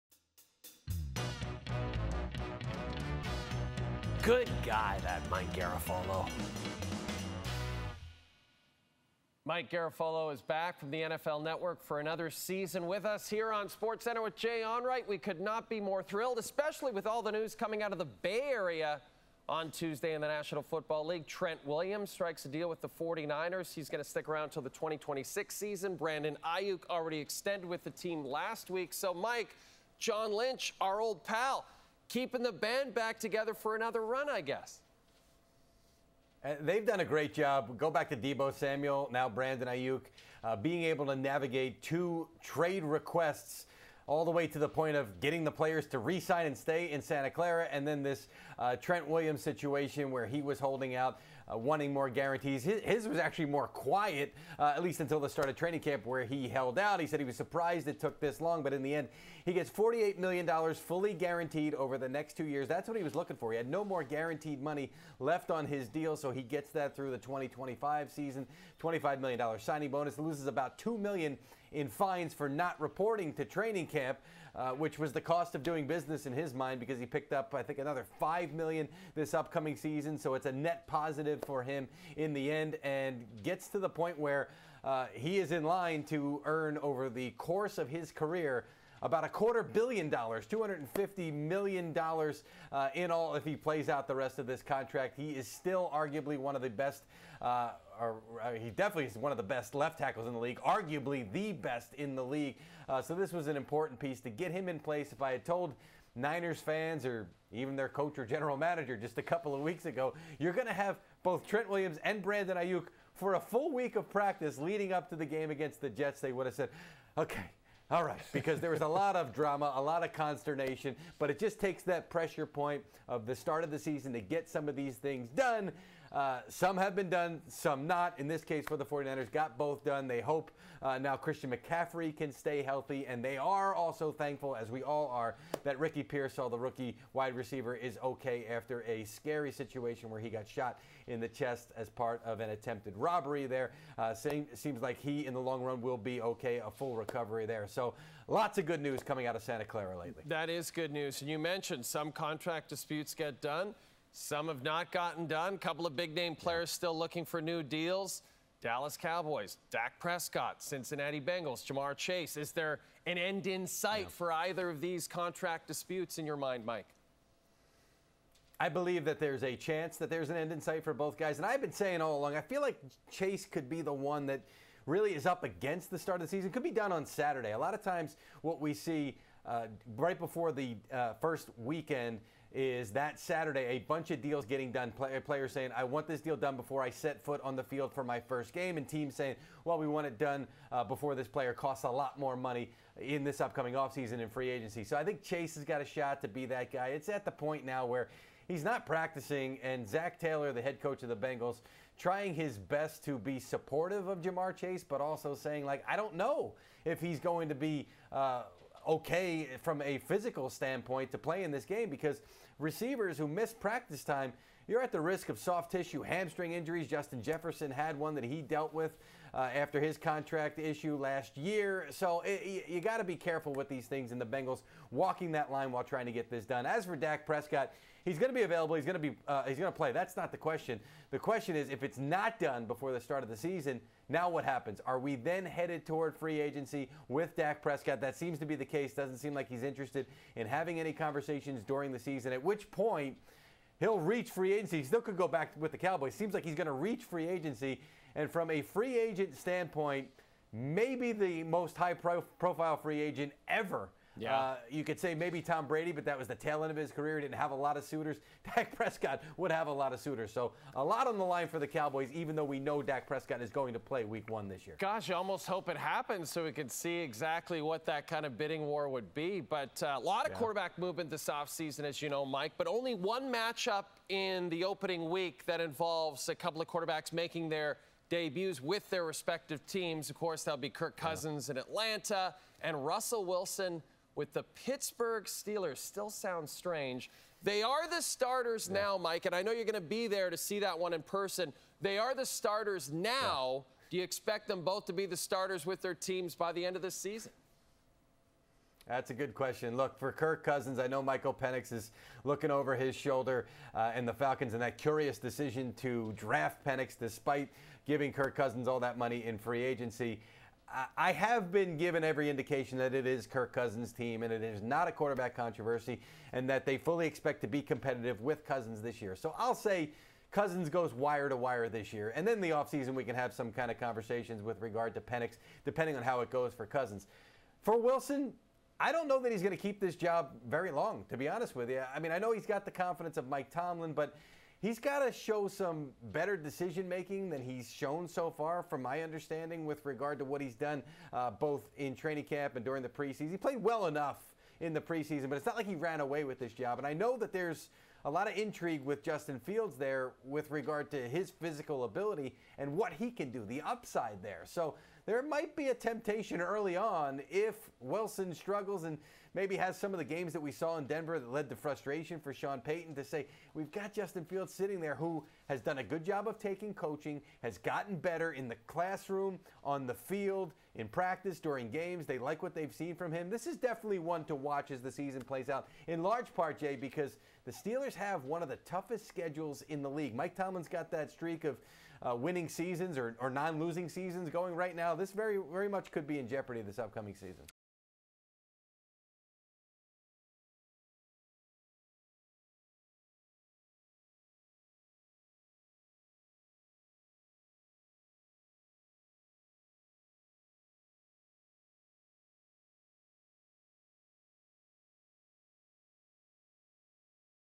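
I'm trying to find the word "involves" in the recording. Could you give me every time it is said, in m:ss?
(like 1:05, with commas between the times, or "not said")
4:35.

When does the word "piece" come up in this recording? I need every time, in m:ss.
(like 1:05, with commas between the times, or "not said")
1:43.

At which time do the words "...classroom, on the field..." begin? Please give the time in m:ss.
6:08.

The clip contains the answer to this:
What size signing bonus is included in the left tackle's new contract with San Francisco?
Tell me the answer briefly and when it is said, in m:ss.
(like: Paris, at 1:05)
$25 million, at 1:08.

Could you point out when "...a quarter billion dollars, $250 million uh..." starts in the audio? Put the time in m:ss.
1:29.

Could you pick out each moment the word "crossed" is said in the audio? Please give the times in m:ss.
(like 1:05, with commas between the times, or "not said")
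not said.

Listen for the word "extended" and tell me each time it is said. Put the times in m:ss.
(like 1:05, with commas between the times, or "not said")
0:27.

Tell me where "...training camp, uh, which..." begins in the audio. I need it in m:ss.
1:13.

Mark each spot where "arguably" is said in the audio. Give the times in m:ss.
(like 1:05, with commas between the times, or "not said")
1:35, 1:40.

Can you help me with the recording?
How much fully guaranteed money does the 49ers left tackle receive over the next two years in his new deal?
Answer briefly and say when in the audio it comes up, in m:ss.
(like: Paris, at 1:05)
$48 million, at 0:59.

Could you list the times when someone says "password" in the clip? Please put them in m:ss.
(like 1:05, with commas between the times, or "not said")
not said.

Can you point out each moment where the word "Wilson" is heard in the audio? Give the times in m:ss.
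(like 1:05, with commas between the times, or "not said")
4:43, 5:27, 5:57.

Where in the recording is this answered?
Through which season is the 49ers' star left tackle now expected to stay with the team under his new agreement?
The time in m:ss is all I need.
0:24.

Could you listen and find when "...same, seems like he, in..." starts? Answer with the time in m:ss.
2:24.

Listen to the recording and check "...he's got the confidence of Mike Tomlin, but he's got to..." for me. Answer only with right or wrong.
right.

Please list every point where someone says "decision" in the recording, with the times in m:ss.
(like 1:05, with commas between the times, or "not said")
5:05, 5:36.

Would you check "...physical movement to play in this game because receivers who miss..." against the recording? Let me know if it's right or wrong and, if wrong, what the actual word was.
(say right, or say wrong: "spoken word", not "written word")
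wrong: "standpoint", not "movement".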